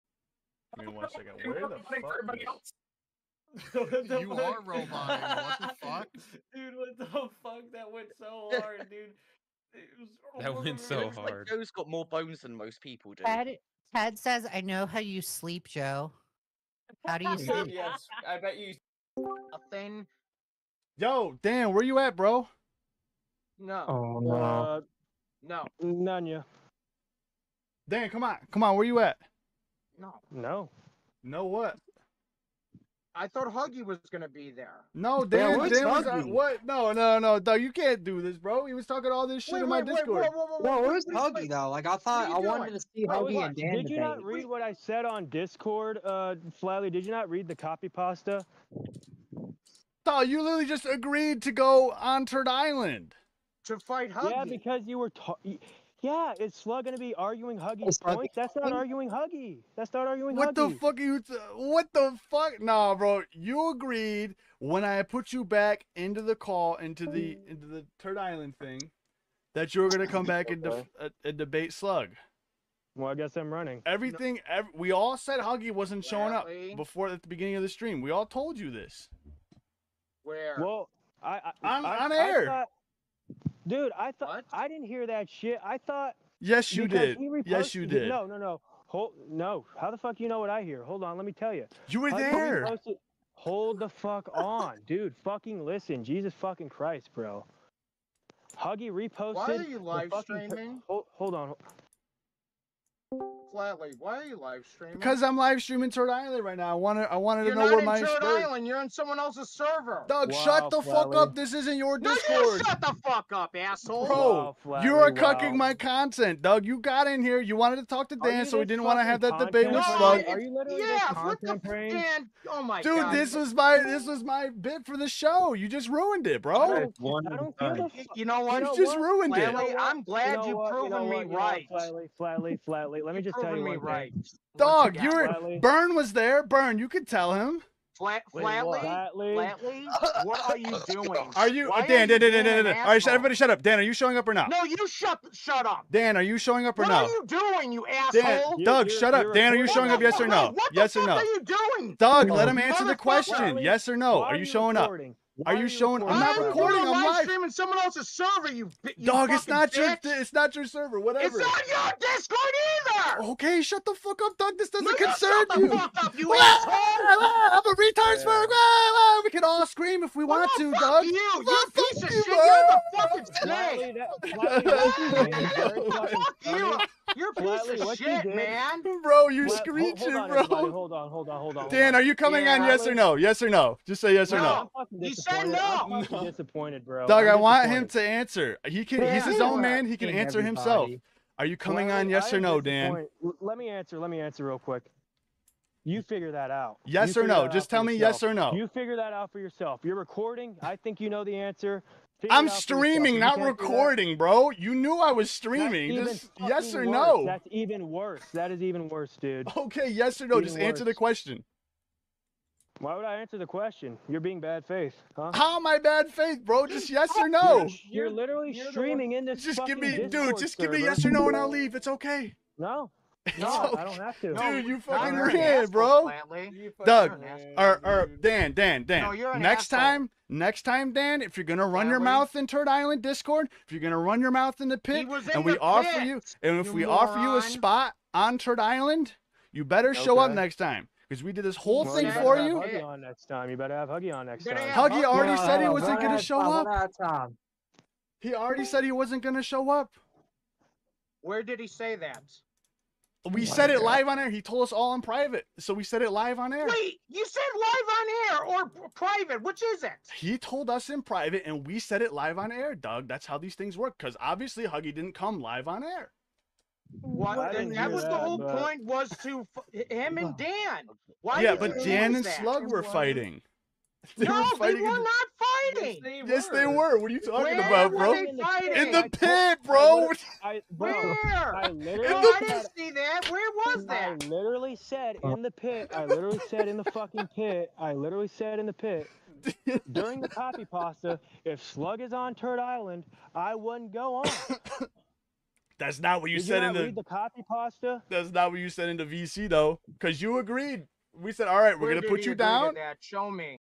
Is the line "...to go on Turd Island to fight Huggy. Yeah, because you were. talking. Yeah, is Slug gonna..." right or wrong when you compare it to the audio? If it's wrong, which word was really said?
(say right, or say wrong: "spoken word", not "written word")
right.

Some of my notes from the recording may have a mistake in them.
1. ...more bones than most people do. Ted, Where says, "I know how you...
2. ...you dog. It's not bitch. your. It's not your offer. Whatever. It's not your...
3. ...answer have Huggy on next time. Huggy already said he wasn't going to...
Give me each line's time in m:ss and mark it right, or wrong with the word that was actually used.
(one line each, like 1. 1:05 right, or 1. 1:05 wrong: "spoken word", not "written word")
1. 0:11 wrong: "Ted", not "Where"
2. 2:38 wrong: "server", not "offer"
3. 4:03 wrong: "better", not "answer".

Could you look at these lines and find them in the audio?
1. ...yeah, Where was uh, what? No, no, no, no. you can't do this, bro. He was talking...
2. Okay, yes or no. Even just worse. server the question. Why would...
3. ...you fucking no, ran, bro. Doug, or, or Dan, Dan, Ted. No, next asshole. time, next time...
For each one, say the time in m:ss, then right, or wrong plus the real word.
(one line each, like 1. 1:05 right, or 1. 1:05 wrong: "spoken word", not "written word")
1. 0:35 wrong: "Dan", not "Where"
2. 3:29 wrong: "answer", not "server"
3. 3:44 wrong: "Dan", not "Ted".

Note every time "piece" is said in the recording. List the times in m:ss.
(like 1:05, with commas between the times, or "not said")
2:51, 2:57.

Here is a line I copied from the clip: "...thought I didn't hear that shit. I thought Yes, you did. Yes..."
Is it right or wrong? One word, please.
right.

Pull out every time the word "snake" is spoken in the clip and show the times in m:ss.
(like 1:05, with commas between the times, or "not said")
2:54.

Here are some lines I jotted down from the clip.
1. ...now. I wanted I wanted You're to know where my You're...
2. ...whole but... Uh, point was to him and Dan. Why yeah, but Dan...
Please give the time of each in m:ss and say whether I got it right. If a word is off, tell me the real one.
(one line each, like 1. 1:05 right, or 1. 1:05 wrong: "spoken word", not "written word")
1. 1:46 right
2. 4:28 right.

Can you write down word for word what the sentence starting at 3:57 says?
offer you a spot on Turd Island, you better show okay.